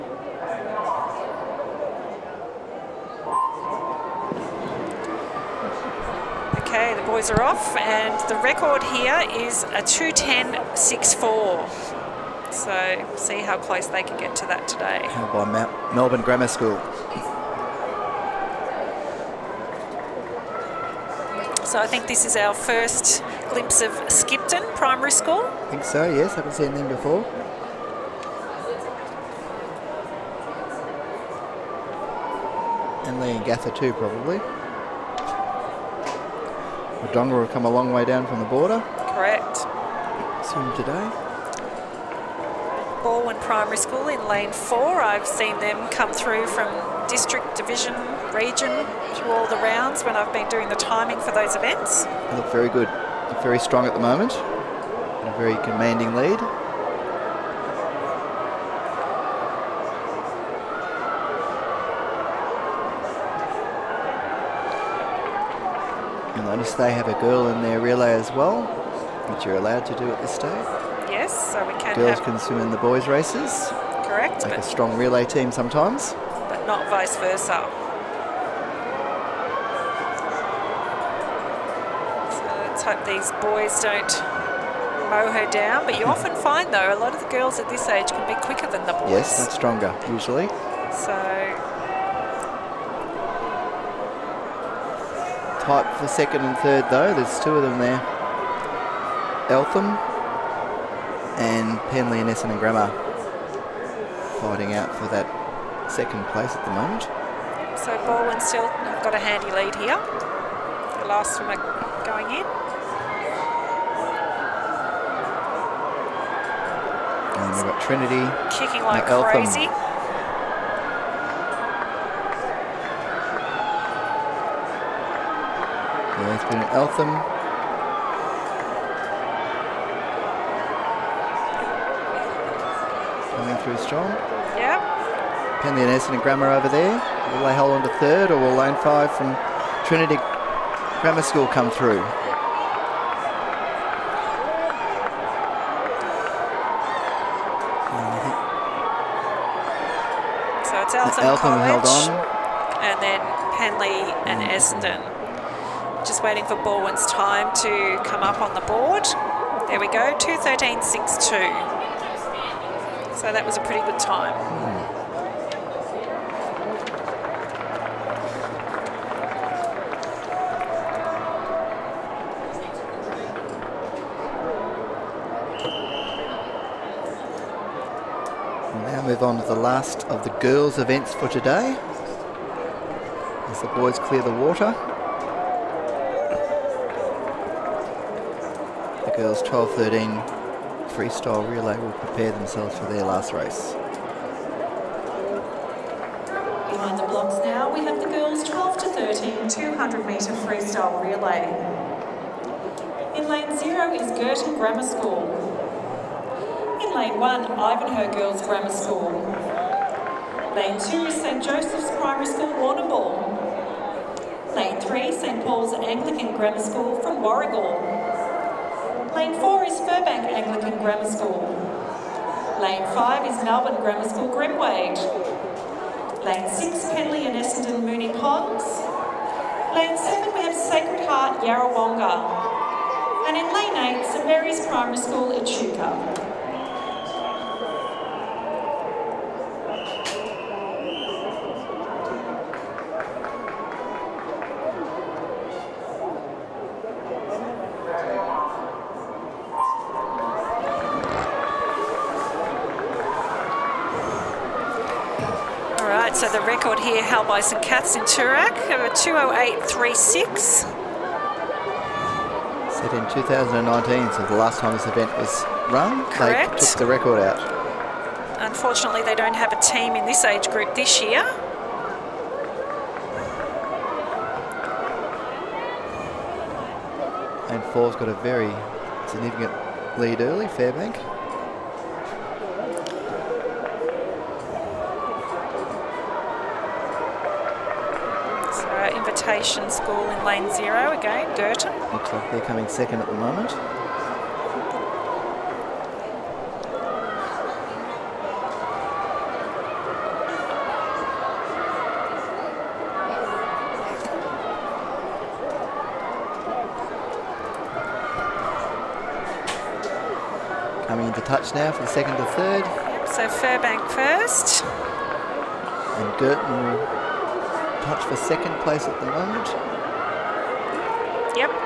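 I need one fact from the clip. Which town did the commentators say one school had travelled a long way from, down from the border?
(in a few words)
Wodonga.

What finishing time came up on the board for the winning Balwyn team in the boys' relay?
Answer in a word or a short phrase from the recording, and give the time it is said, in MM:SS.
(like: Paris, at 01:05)
2.13.62, at 02:40.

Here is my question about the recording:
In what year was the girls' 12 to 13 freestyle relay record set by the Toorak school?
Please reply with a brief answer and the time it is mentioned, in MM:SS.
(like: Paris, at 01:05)
2019, at 04:23.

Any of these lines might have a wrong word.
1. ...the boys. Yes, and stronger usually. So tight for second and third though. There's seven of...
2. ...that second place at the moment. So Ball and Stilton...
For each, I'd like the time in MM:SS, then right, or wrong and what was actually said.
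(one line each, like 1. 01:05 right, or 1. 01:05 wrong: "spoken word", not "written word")
1. 01:28 wrong: "two", not "seven"
2. 01:45 right.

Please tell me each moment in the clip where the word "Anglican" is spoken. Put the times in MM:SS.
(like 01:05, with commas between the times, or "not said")
03:35, 03:40.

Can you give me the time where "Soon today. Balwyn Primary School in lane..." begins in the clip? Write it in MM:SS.
00:40.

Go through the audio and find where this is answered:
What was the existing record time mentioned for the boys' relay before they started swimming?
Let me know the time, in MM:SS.
00:09.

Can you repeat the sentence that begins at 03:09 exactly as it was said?
The girls 12-13 freestyle relay will prepare themselves for their last race.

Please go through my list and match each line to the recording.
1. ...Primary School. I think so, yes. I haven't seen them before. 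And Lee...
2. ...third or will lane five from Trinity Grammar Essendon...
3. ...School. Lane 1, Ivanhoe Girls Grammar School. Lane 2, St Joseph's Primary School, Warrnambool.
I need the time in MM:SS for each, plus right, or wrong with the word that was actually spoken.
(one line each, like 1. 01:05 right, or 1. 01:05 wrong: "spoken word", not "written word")
1. 00:24 right
2. 02:17 wrong: "School", not "Essendon"
3. 03:24 right.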